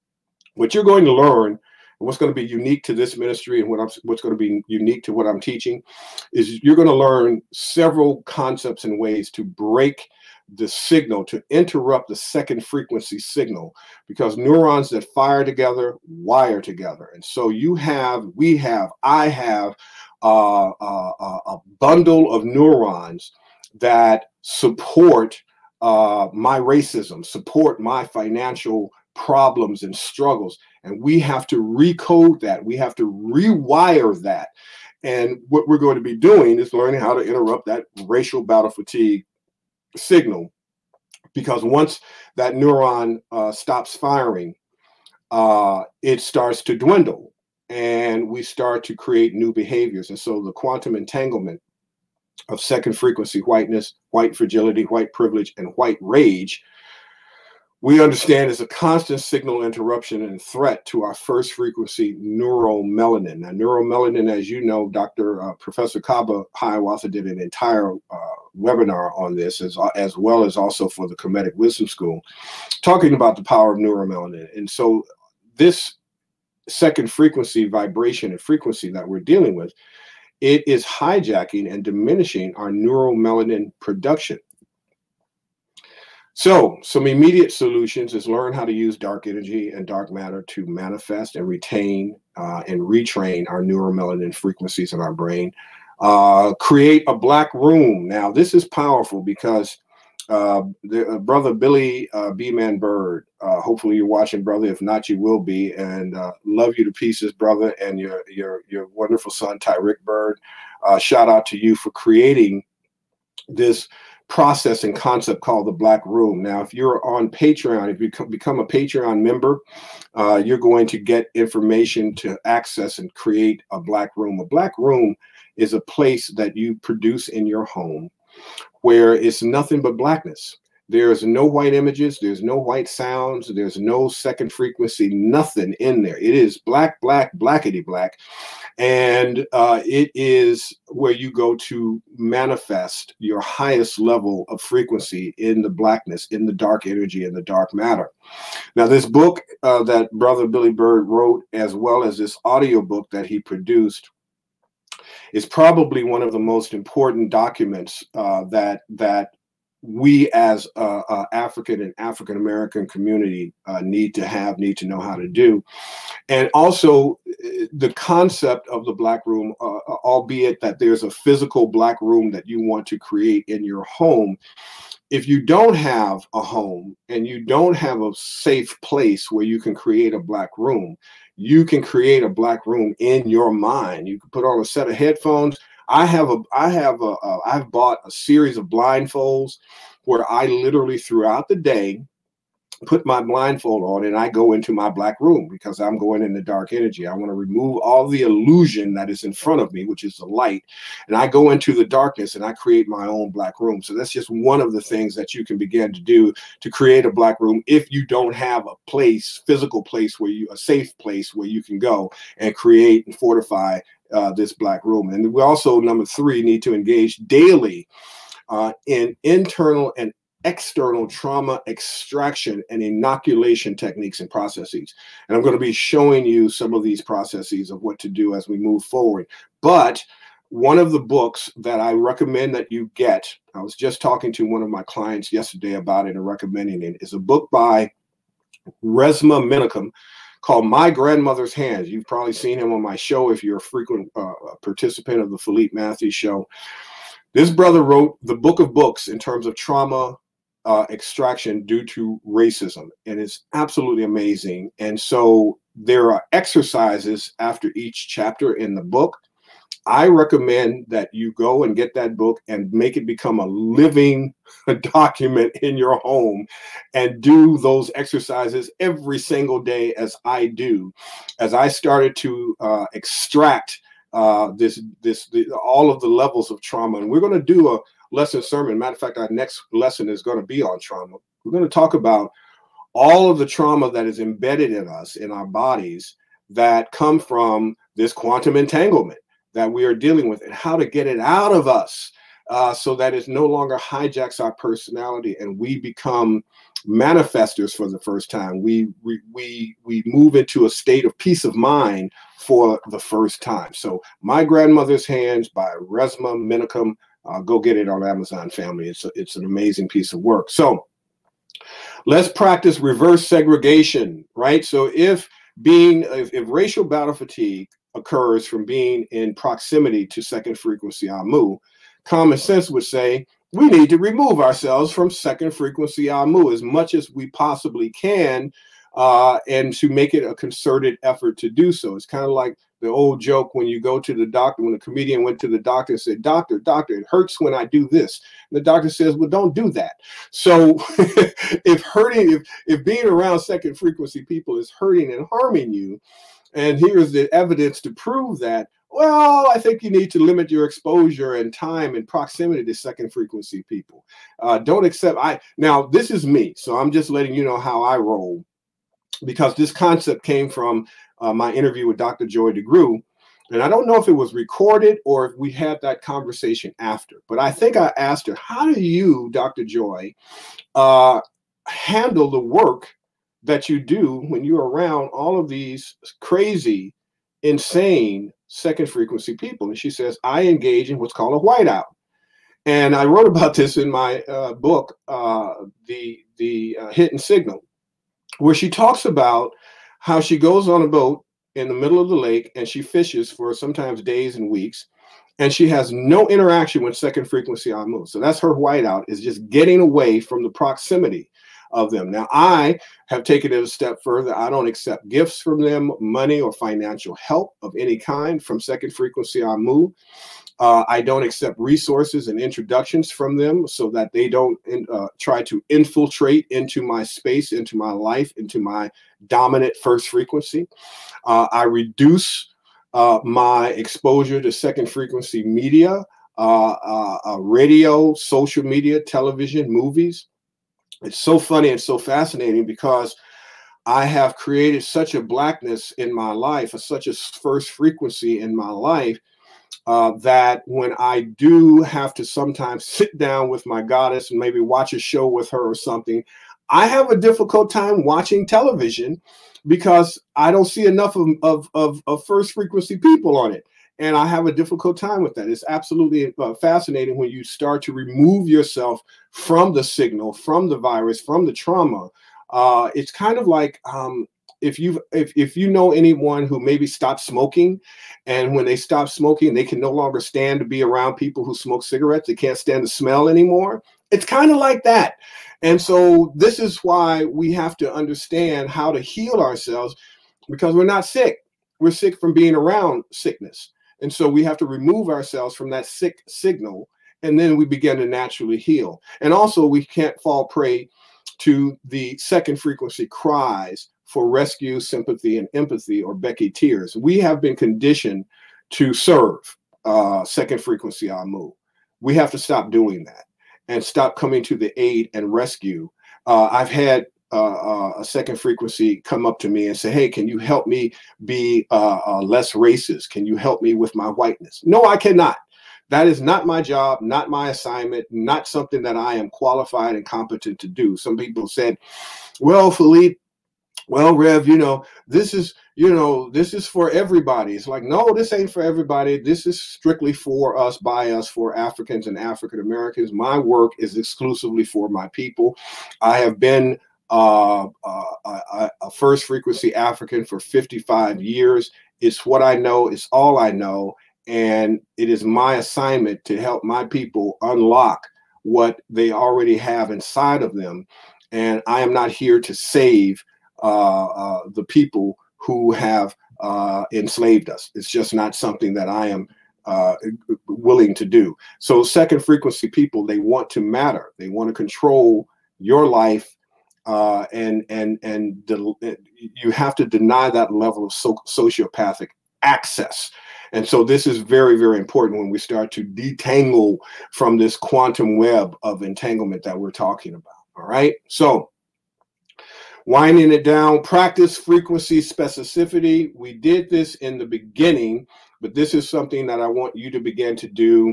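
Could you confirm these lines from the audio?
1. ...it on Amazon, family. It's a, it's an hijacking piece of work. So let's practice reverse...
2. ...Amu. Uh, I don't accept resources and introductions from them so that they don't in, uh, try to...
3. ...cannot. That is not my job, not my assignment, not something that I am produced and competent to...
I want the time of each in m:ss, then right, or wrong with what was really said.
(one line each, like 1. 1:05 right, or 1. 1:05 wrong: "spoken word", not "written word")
1. 5:07 wrong: "amazing", not "hijacking"
2. 6:49 right
3. 8:34 wrong: "qualified", not "produced".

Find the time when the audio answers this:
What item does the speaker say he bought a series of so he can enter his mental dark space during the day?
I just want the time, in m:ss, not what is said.
3:08.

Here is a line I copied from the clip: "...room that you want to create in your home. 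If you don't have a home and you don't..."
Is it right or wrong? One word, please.
right.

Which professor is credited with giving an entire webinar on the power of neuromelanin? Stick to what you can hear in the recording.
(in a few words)
Kaba Hiawatha.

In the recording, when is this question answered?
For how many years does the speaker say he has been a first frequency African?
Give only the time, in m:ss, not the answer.
9:00.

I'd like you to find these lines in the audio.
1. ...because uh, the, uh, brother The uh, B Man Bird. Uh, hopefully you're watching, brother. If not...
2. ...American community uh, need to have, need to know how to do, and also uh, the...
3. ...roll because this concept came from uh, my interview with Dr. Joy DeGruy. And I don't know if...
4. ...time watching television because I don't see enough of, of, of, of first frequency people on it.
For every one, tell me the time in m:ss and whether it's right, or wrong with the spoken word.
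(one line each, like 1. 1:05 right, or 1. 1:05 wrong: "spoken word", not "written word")
1. 1:39 wrong: "Billy", not "The"
2. 2:42 right
3. 5:57 right
4. 7:27 right.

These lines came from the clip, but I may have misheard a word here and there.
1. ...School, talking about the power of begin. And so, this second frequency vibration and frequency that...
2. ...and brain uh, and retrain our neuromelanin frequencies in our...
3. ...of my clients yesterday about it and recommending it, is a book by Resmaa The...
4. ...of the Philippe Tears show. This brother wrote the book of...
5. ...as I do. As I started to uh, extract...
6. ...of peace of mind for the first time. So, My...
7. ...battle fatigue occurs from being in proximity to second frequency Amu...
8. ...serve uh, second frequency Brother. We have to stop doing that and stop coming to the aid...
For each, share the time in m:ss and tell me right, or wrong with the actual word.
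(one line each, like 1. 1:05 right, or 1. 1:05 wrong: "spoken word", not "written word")
1. 1:11 wrong: "neuromelanin", not "begin"
2. 1:31 wrong: "retain", not "brain"
3. 3:54 wrong: "Menakem", not "The"
4. 4:05 wrong: "Matthews", not "Tears"
5. 4:29 right
6. 5:01 right
7. 5:16 right
8. 8:18 wrong: "Amu", not "Brother".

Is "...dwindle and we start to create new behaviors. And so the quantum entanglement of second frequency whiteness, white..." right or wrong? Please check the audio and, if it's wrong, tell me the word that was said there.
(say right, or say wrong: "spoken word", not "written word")
right.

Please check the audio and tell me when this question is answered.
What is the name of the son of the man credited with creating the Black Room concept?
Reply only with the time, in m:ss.
1:49.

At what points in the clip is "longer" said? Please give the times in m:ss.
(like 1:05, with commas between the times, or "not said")
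4:53, 7:49.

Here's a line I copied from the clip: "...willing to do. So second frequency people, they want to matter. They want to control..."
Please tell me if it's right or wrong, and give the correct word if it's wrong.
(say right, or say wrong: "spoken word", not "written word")
right.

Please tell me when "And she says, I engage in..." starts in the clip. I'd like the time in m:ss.
6:19.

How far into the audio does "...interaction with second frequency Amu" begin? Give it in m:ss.
6:36.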